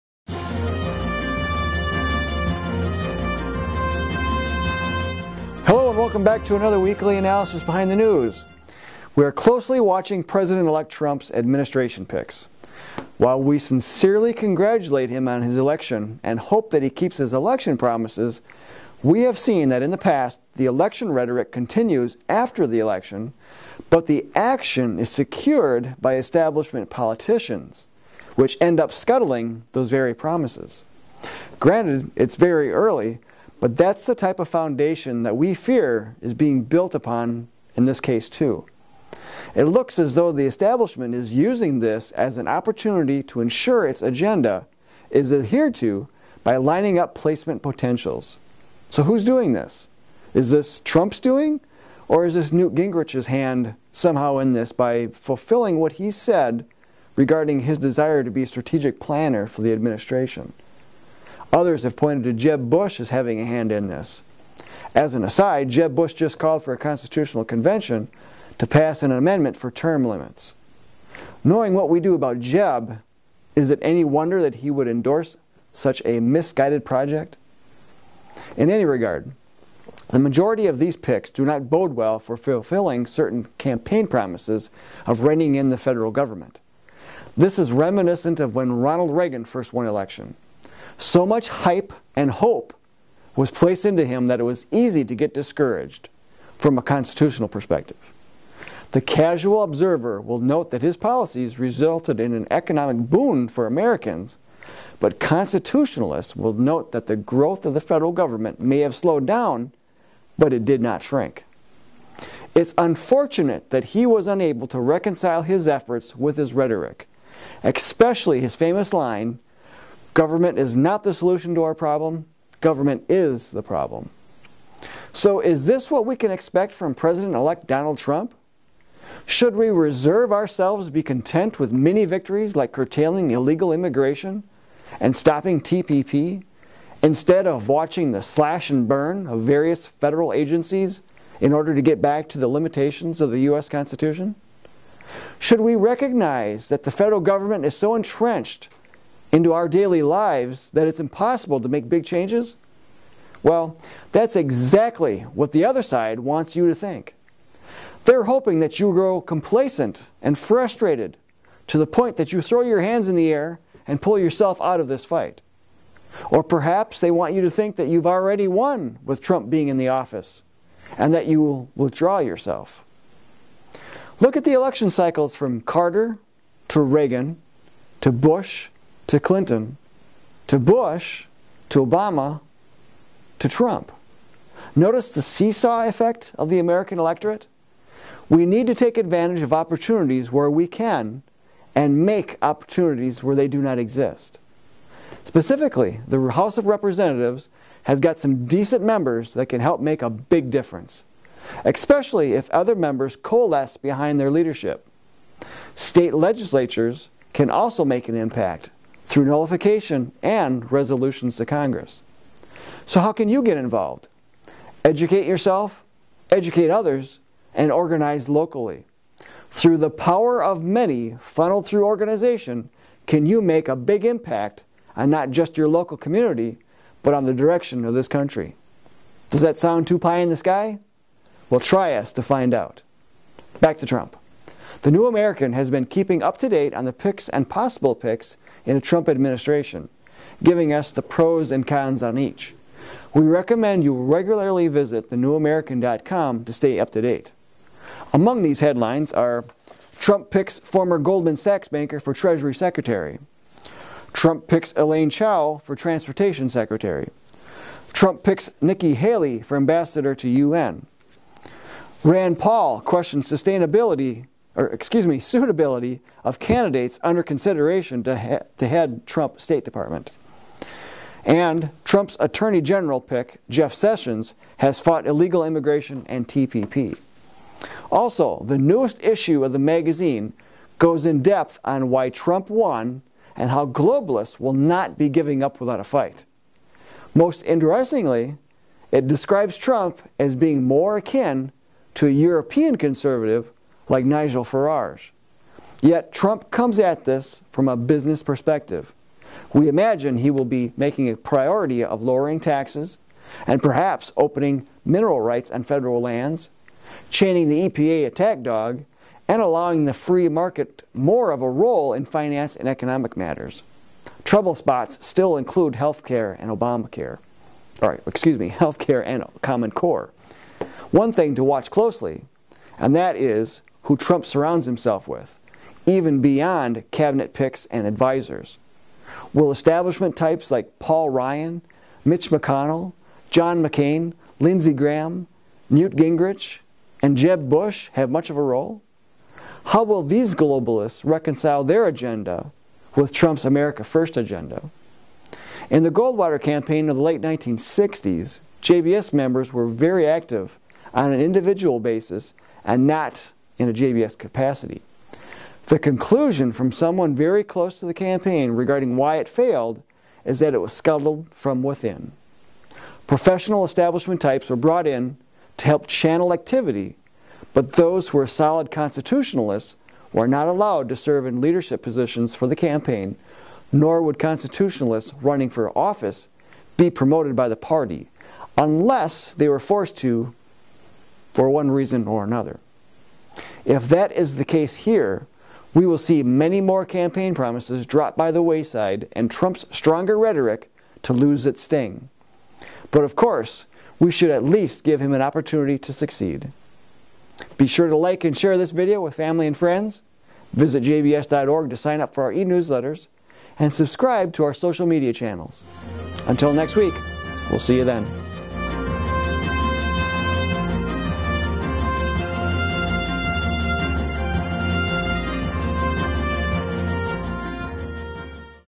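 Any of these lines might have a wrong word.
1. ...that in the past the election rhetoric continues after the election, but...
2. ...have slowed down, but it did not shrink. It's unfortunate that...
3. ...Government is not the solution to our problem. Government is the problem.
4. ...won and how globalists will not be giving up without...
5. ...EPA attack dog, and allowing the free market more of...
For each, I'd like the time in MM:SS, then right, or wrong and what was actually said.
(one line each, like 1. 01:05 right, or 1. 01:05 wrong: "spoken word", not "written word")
1. 00:19 right
2. 01:48 right
3. 02:00 right
4. 04:42 right
5. 05:07 right.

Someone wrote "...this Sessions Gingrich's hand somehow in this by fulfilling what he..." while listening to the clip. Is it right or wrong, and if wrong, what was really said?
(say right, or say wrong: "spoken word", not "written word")
wrong: "Newt", not "Sessions".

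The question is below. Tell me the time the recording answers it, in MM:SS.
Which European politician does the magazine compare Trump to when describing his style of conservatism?
04:54.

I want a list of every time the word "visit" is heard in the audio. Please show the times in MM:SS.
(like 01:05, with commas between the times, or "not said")
04:04, 06:40.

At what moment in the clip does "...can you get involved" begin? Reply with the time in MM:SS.
03:33.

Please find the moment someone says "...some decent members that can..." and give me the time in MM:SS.
03:18.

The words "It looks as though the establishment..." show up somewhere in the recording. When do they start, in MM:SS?
00:39.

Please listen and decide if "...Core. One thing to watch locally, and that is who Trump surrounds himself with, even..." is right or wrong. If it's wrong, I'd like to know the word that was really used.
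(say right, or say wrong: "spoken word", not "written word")
wrong: "closely", not "locally".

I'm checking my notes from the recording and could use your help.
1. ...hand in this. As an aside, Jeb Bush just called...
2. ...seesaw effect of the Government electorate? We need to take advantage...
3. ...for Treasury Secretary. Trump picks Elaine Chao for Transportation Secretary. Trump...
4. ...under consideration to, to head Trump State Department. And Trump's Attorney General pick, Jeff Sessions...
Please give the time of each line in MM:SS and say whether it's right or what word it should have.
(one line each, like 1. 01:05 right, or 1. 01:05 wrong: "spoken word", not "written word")
1. 01:03 right
2. 03:05 wrong: "American", not "Government"
3. 04:11 right
4. 04:27 right.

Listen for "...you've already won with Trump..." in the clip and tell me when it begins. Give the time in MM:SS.
02:47.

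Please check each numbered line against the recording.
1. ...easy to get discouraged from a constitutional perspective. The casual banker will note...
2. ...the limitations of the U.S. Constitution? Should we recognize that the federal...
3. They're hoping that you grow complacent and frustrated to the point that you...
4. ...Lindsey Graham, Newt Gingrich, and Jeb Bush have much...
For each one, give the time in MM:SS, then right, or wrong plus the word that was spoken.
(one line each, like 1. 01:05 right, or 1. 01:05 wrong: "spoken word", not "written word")
1. 01:34 wrong: "observer", not "banker"
2. 02:22 right
3. 02:38 right
4. 05:34 right.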